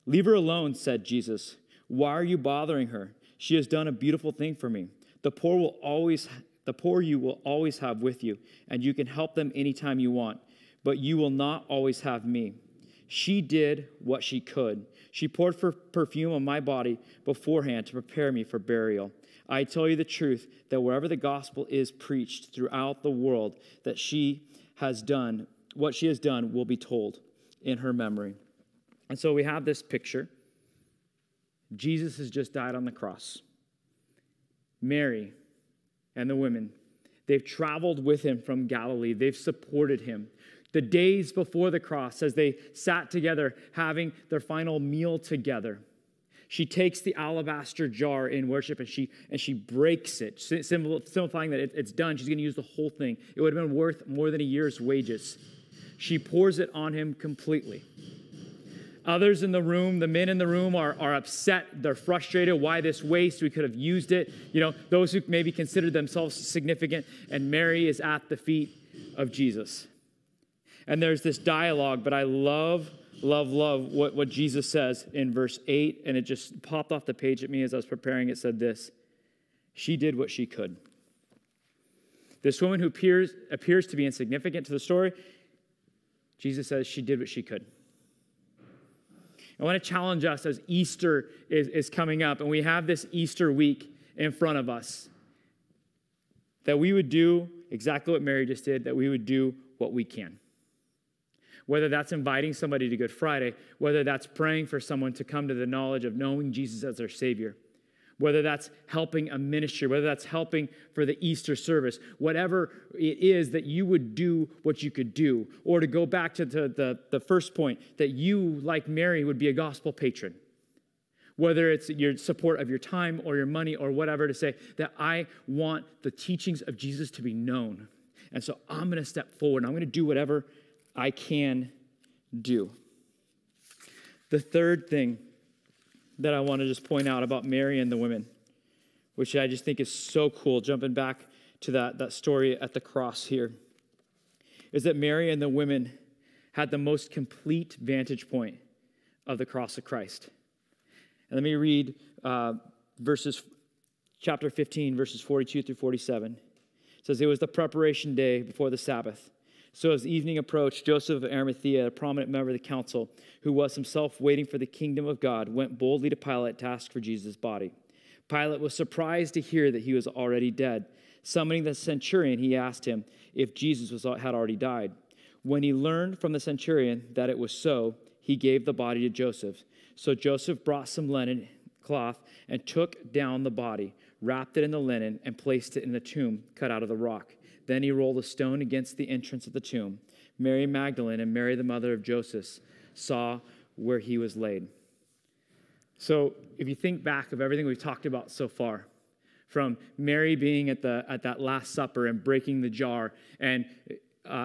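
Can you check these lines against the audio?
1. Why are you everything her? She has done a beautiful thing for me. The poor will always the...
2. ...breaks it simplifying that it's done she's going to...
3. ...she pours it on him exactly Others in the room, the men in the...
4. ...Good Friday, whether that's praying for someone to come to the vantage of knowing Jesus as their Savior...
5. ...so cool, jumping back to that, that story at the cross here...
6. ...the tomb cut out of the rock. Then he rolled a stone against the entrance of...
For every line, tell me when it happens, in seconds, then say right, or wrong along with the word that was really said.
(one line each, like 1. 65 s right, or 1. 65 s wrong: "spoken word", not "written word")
1. 1 s wrong: "bothering", not "everything"
2. 49 s right
3. 55 s wrong: "completely", not "exactly"
4. 102 s wrong: "knowledge", not "vantage"
5. 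139 s right
6. 185 s right.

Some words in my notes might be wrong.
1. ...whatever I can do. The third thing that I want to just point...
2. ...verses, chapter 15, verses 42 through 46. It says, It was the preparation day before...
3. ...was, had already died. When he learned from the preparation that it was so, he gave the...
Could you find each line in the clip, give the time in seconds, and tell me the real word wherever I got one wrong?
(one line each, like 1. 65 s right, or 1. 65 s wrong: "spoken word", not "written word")
1. 130 s right
2. 152 s wrong: "47", not "46"
3. 173 s wrong: "centurion", not "preparation".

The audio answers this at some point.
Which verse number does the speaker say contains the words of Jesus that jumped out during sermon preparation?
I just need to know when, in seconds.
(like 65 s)
75 s.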